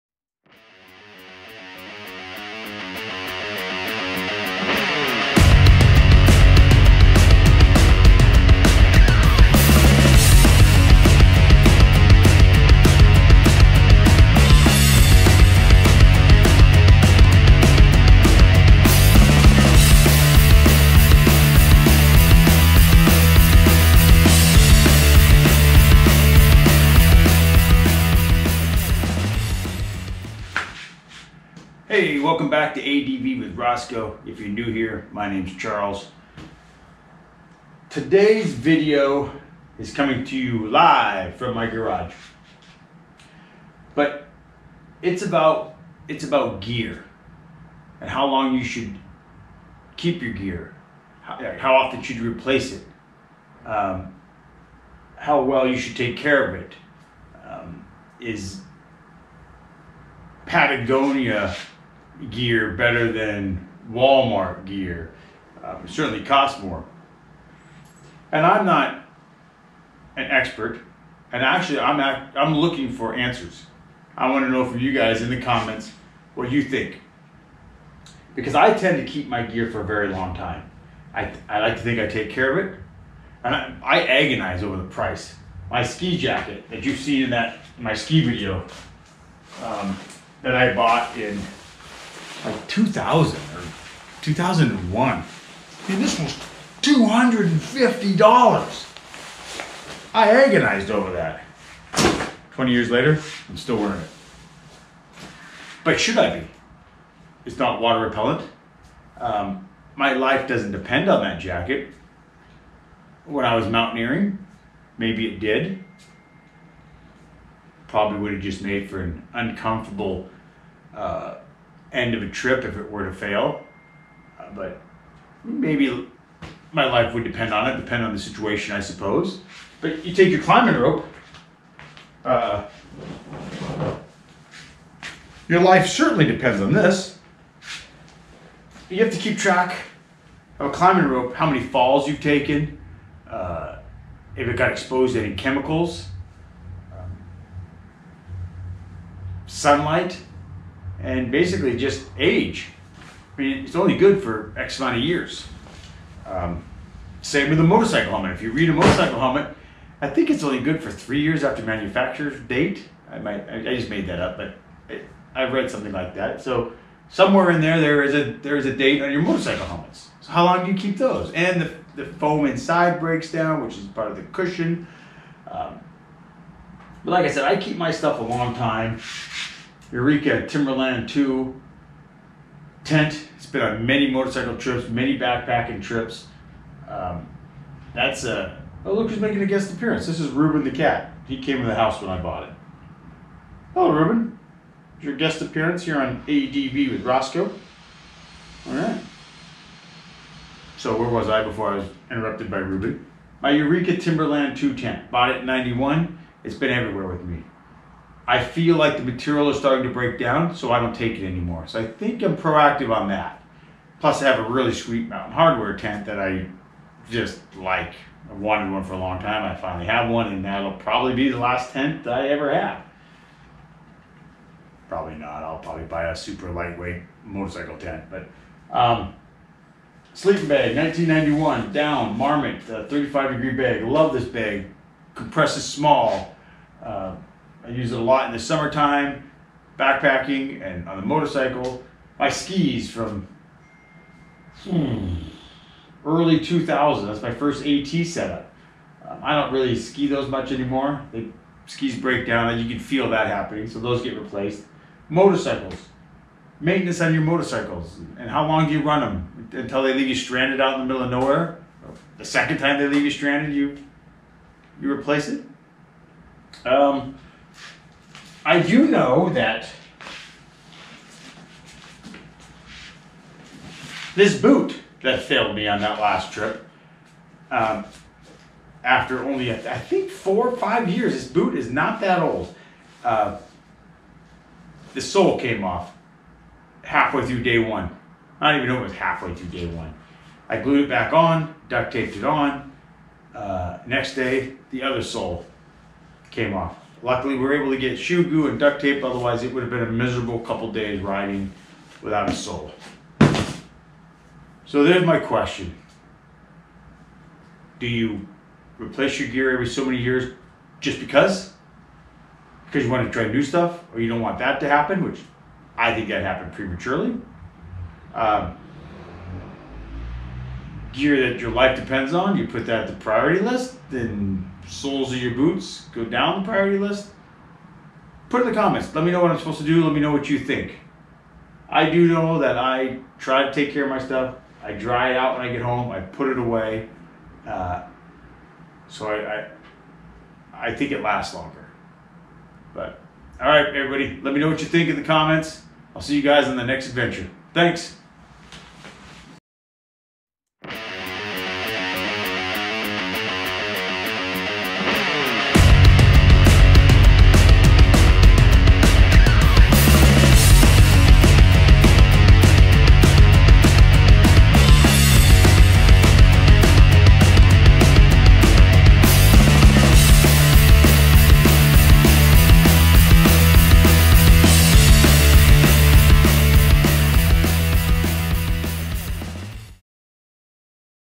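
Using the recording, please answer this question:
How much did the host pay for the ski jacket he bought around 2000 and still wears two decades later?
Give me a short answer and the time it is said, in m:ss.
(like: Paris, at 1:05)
$250, at 1:36.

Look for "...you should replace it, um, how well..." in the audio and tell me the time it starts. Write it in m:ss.
0:51.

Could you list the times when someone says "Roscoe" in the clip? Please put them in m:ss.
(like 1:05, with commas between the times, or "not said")
0:33, 3:17.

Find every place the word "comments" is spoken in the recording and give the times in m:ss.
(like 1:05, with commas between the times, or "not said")
1:15, 5:28, 5:45.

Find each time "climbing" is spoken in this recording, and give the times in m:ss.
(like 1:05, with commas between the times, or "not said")
2:10, 2:20.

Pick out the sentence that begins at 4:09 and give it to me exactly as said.
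Um, I don't really ski those much anymore.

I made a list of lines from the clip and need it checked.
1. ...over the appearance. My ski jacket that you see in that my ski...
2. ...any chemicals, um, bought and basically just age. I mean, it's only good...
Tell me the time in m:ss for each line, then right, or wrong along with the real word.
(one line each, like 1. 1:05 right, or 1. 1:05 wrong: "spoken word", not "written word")
1. 1:24 wrong: "price", not "appearance"
2. 2:25 wrong: "sunlight", not "bought".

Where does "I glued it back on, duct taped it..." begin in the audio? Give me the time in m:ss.
4:50.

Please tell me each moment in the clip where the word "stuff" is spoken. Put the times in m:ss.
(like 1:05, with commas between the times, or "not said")
2:57, 5:13, 5:33.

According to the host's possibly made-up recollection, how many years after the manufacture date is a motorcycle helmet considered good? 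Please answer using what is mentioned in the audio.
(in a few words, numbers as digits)
3 years.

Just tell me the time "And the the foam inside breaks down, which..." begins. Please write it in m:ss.
2:51.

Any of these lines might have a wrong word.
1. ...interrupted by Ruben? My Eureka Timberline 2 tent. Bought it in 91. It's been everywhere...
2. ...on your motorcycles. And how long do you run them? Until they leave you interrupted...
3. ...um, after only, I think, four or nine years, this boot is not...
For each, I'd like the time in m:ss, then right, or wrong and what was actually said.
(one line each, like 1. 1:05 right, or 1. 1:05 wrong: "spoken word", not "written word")
1. 3:22 right
2. 4:17 wrong: "stranded", not "interrupted"
3. 4:37 wrong: "five", not "nine".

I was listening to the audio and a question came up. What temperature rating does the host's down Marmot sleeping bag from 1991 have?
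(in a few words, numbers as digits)
35 degrees.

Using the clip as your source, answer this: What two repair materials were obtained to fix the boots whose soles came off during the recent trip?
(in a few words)
shoe goo and duct tape.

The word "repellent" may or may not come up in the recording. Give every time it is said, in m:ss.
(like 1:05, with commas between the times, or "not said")
1:48.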